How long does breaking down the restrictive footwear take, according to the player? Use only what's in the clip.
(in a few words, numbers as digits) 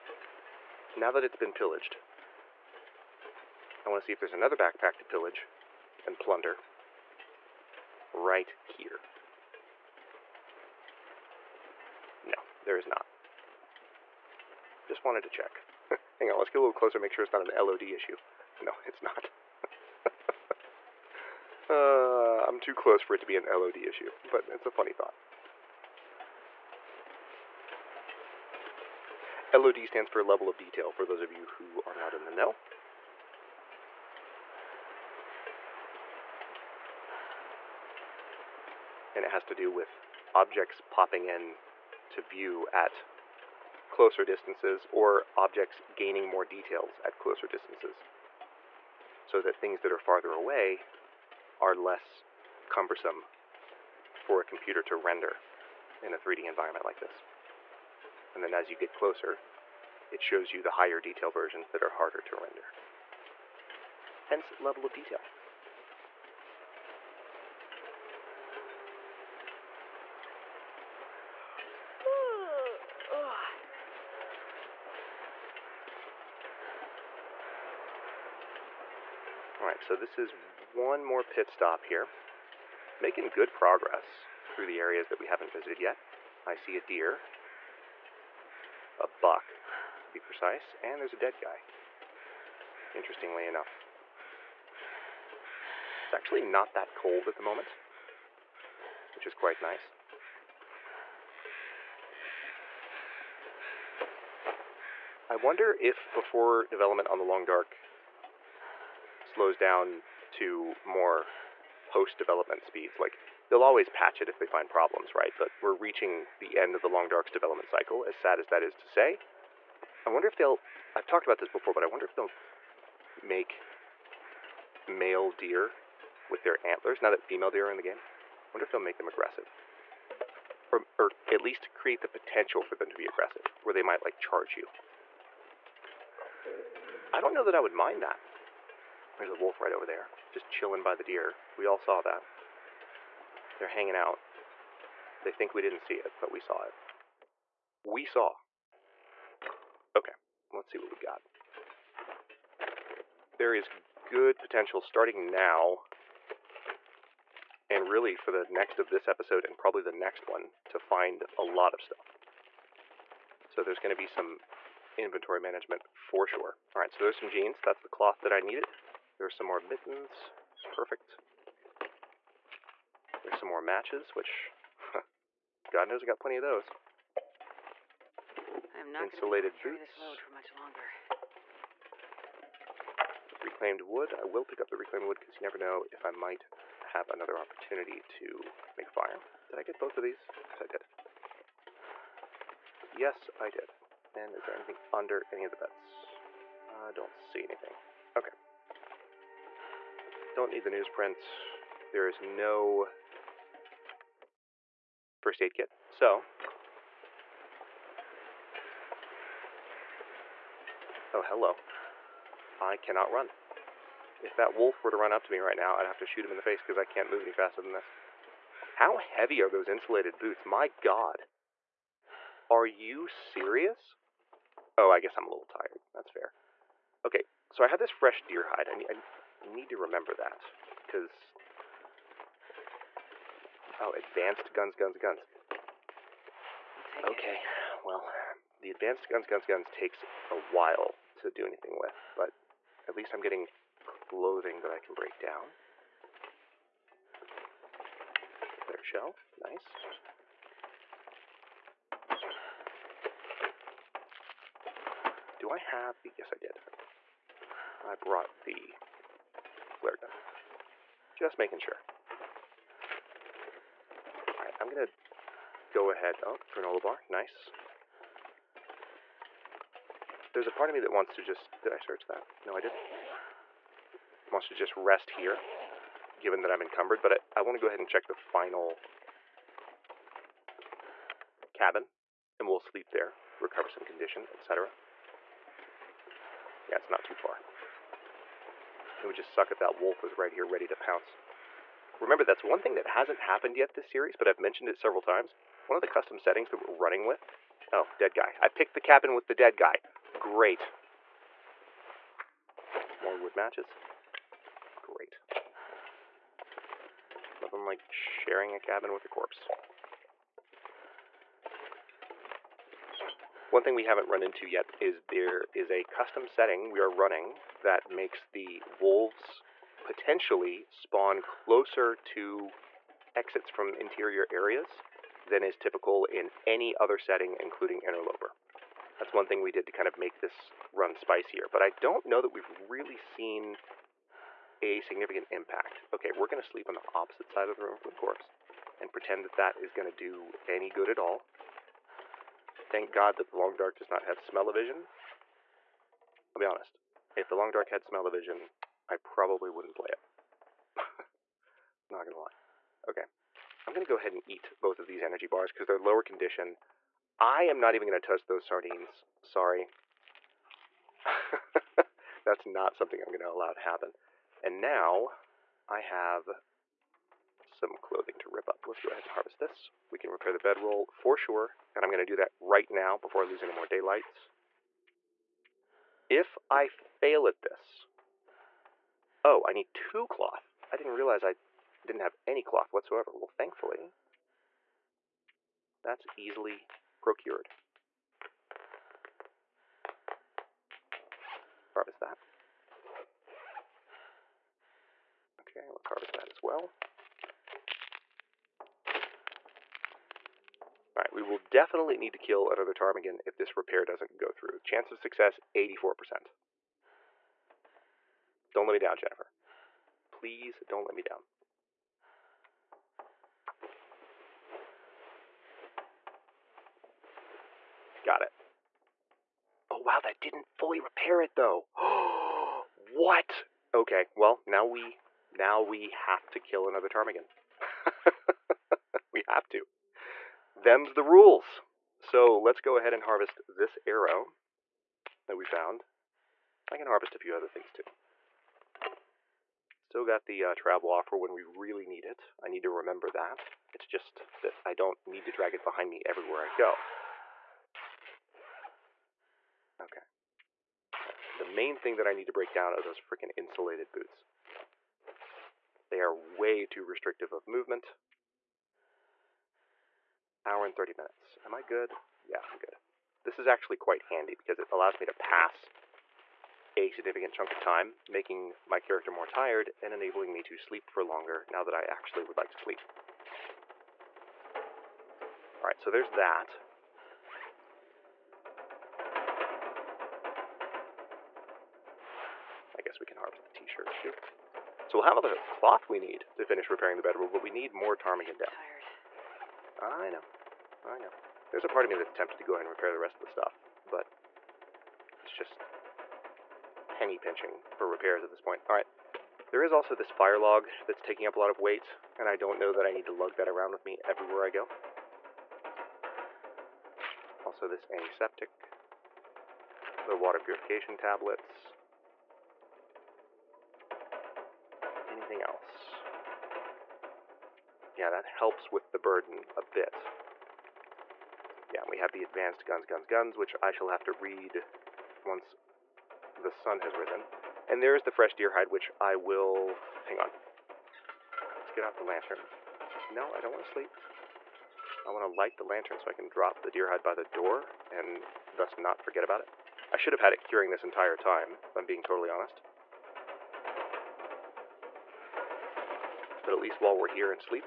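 1 hour 30 minutes.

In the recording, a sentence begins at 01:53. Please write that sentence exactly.
Like they'll always patch it if they find problems, right?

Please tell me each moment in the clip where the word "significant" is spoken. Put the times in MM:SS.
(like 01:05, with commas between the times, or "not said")
05:34, 07:46.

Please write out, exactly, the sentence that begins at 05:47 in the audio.
If the Long Dark had smell of vision I probably wouldn't play it.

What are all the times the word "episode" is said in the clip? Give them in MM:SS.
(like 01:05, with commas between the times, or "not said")
02:39.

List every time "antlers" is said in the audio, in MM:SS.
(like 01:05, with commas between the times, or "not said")
02:06.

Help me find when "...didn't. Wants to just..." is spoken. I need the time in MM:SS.
04:32.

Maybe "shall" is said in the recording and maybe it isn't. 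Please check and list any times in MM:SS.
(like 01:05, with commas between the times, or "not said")
08:43.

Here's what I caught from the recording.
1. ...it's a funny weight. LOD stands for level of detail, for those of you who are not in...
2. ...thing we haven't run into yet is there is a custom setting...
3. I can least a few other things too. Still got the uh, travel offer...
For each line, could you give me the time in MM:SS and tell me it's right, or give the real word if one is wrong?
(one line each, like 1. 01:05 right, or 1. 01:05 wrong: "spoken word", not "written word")
1. 00:24 wrong: "thought", not "weight"
2. 05:13 right
3. 07:16 wrong: "harvest", not "least".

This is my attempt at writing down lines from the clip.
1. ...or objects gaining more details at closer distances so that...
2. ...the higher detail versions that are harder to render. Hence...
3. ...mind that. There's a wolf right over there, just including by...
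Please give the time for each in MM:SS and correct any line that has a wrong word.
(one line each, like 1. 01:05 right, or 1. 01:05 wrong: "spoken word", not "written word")
1. 00:44 right
2. 01:00 right
3. 02:17 wrong: "chilling", not "including".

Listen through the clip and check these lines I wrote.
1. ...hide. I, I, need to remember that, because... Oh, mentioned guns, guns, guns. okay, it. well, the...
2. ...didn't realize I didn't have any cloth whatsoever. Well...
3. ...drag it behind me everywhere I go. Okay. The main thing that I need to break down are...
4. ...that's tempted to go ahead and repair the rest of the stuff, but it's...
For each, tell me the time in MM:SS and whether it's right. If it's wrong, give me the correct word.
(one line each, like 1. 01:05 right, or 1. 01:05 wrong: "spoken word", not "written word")
1. 03:48 wrong: "advanced", not "mentioned"
2. 06:20 right
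3. 07:25 right
4. 08:11 right.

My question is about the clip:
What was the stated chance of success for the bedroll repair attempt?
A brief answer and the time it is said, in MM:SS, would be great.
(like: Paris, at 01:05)
84%, at 06:45.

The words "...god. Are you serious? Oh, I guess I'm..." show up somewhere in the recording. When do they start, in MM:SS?
03:40.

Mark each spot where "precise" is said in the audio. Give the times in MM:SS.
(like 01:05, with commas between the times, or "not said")
01:30.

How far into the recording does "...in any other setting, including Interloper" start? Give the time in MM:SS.
05:26.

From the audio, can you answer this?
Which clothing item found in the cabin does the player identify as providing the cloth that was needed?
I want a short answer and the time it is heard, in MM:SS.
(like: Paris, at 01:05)
Jeans, at 02:47.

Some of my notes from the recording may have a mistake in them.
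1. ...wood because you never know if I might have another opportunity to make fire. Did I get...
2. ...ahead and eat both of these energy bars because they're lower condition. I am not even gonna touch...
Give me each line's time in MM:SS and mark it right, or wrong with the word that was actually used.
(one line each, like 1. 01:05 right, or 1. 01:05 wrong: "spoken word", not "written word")
1. 03:05 right
2. 05:53 right.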